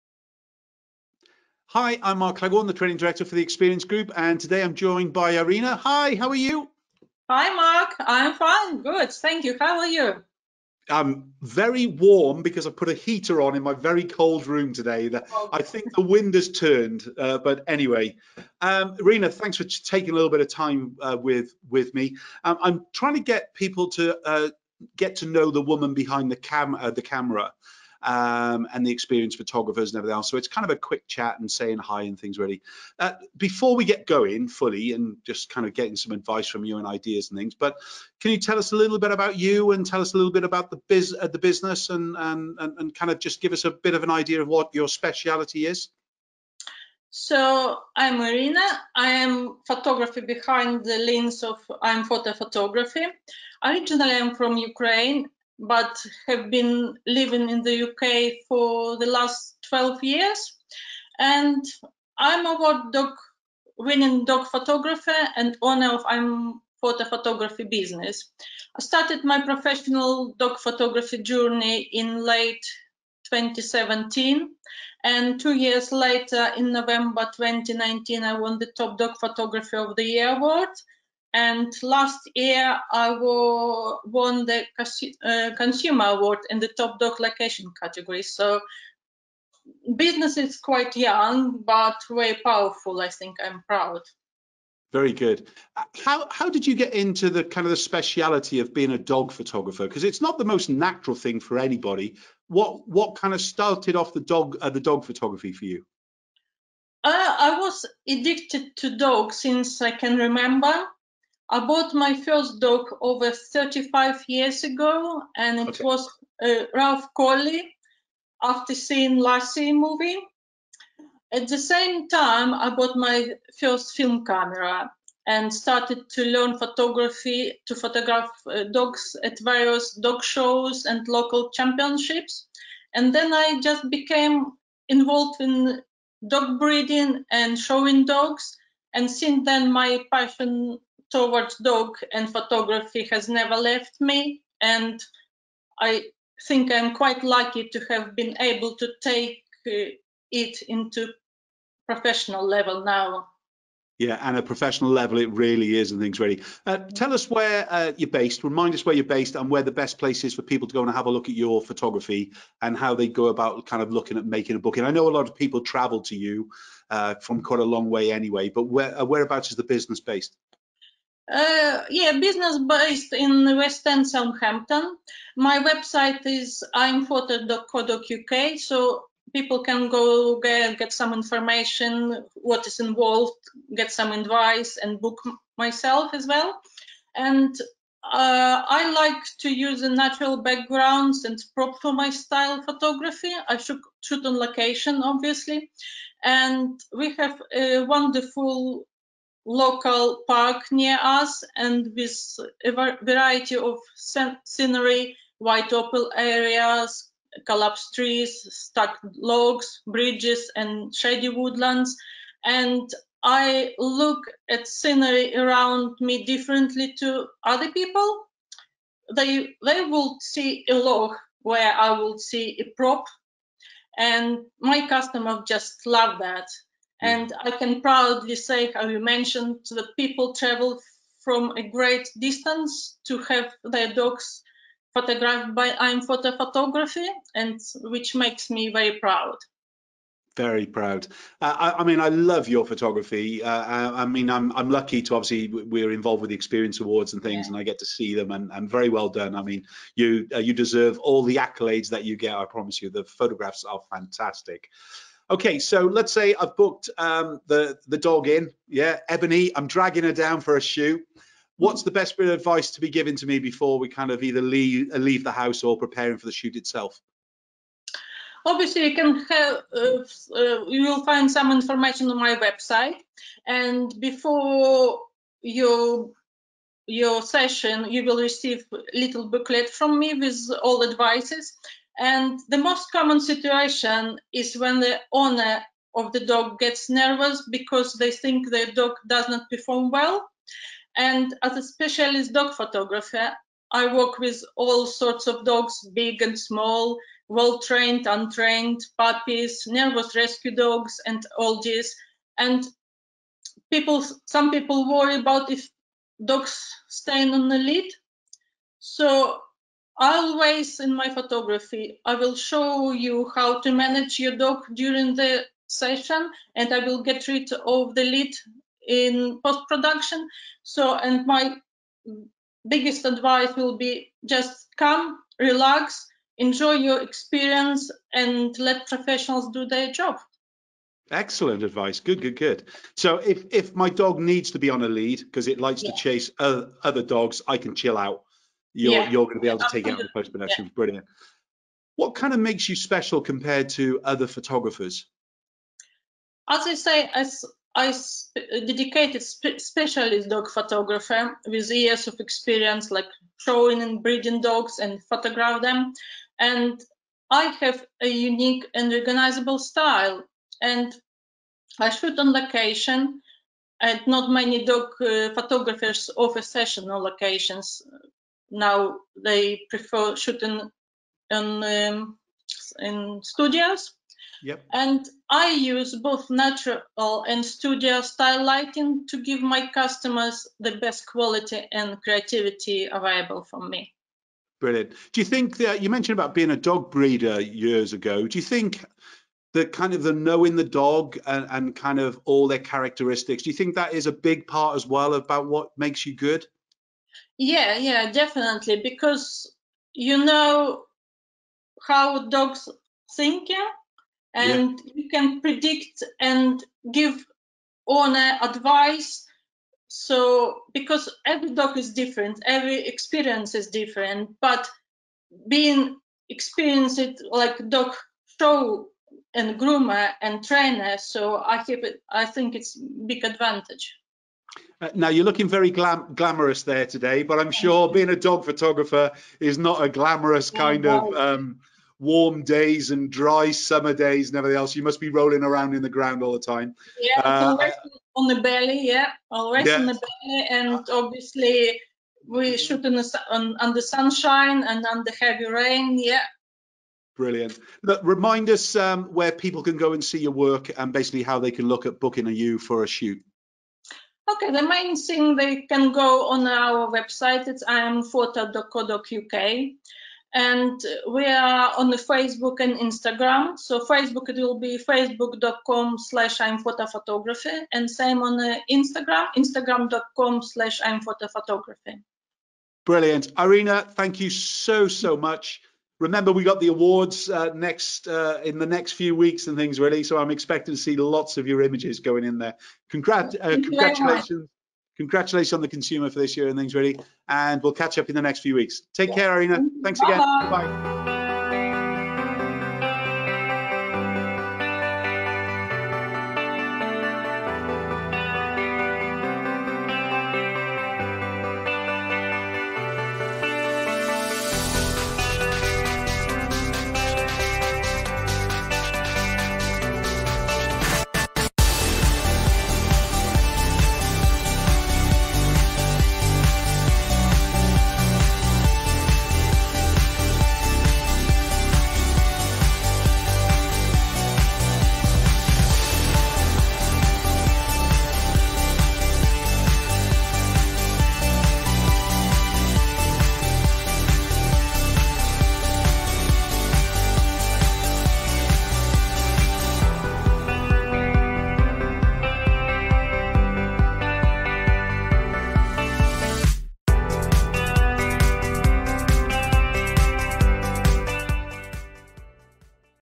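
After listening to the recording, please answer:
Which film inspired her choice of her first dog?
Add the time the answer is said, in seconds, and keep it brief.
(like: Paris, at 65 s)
Lassie, at 119 s.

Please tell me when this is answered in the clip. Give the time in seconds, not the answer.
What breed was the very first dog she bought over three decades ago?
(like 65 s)
116 s.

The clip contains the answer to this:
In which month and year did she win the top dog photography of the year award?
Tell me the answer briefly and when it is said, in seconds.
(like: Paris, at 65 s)
November 2019, at 76 s.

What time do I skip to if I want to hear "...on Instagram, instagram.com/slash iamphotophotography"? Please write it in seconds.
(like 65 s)
468 s.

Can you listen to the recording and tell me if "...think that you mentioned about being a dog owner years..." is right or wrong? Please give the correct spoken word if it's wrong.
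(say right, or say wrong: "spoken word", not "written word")
wrong: "breeder", not "owner".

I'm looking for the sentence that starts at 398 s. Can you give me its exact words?
Because you know how dogs think and yeah.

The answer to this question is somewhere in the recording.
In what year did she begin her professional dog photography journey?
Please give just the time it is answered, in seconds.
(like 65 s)
72 s.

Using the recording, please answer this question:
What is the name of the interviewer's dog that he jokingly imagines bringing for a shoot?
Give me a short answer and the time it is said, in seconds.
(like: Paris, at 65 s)
Ebony, at 259 s.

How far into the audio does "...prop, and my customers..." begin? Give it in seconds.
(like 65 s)
222 s.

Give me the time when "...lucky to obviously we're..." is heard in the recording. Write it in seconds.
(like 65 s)
244 s.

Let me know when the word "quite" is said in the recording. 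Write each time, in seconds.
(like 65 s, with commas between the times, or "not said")
90 s, 146 s, 167 s.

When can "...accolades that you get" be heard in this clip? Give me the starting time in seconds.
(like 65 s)
251 s.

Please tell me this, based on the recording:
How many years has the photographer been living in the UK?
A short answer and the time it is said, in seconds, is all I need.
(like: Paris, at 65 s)
12, at 59 s.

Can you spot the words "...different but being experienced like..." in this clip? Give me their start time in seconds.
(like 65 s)
413 s.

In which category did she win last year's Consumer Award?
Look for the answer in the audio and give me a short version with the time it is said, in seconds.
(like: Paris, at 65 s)
Top Dog Location, at 86 s.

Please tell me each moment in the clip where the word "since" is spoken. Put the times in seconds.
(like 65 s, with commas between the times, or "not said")
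109 s, 139 s.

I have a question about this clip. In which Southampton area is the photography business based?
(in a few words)
West End.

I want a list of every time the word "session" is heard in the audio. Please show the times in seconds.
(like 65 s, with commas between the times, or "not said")
277 s, 315 s, 366 s.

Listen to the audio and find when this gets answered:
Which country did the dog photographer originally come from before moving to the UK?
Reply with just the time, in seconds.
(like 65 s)
54 s.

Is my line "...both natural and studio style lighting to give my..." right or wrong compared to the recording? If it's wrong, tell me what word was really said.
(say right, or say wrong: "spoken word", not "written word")
right.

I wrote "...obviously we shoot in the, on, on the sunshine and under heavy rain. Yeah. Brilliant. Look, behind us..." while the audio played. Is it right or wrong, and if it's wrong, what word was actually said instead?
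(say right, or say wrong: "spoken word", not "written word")
wrong: "remind", not "behind".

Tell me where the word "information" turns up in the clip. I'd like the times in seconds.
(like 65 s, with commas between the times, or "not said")
181 s, 271 s.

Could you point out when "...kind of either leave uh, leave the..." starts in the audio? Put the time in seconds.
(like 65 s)
263 s.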